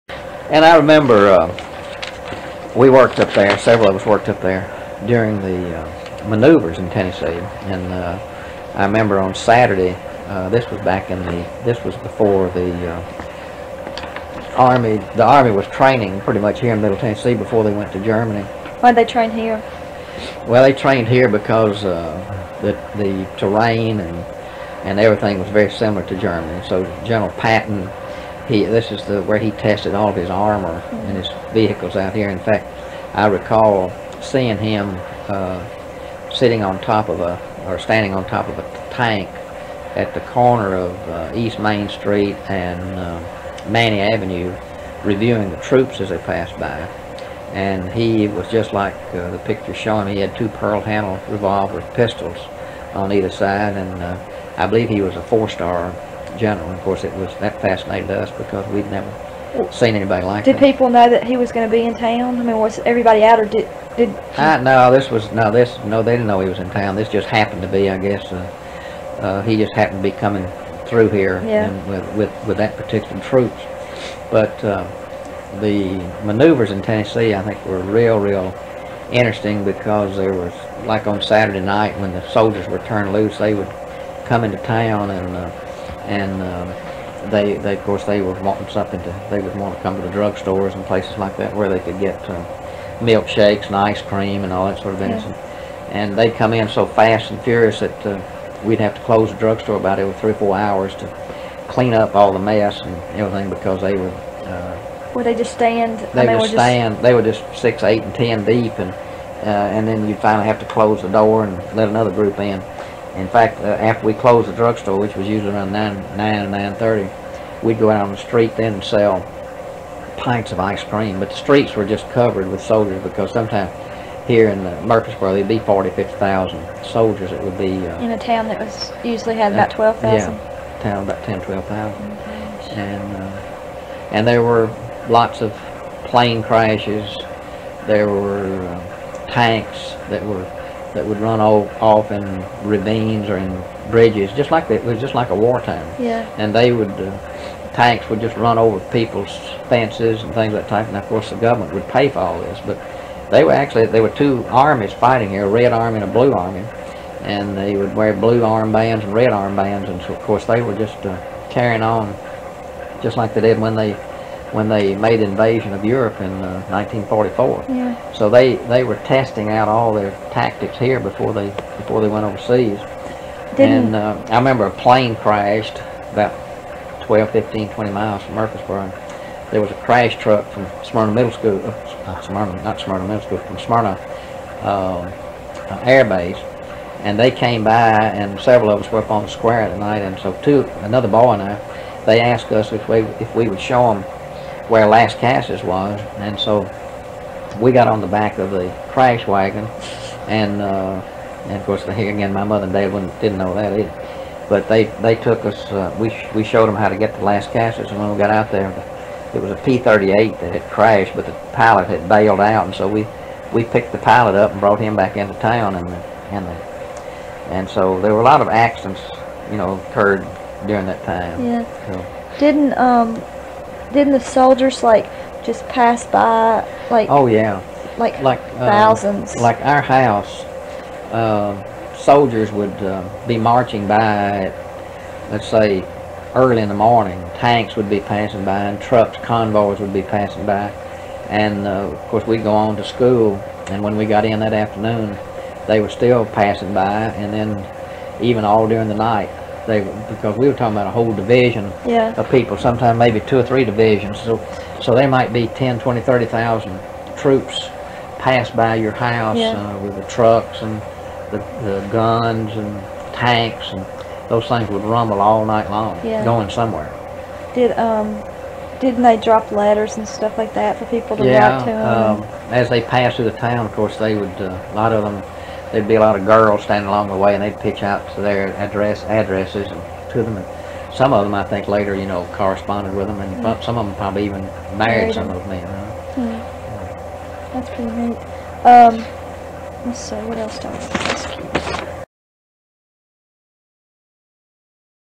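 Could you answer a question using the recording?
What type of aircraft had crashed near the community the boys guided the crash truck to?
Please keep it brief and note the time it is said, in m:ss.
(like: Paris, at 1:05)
P-38, at 3:29.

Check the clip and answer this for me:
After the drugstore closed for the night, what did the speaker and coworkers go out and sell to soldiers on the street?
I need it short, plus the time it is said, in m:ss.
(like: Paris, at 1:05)
Pints of ice cream, at 2:00.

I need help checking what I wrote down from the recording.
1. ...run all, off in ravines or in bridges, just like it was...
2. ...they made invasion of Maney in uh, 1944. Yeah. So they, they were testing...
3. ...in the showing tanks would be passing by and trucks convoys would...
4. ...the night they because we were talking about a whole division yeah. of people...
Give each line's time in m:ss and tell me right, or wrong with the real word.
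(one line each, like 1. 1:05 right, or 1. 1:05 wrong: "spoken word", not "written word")
1. 2:21 right
2. 2:44 wrong: "Europe", not "Maney"
3. 3:56 wrong: "morning", not "showing"
4. 4:08 right.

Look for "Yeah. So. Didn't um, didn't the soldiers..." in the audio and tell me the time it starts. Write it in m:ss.
3:41.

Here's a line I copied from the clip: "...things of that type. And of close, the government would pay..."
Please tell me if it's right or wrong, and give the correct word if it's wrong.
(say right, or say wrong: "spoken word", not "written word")
wrong: "course", not "close".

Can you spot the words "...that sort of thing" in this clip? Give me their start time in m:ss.
1:34.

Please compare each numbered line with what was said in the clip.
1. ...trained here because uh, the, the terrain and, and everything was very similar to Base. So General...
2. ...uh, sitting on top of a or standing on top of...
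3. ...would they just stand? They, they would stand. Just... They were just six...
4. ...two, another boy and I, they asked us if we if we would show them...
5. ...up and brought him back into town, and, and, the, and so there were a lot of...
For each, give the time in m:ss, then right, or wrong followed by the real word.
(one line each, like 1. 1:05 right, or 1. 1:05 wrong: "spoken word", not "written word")
1. 0:20 wrong: "Germany", not "Base"
2. 0:35 right
3. 1:45 right
4. 3:10 right
5. 3:34 right.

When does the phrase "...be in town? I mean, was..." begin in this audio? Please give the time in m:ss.
1:01.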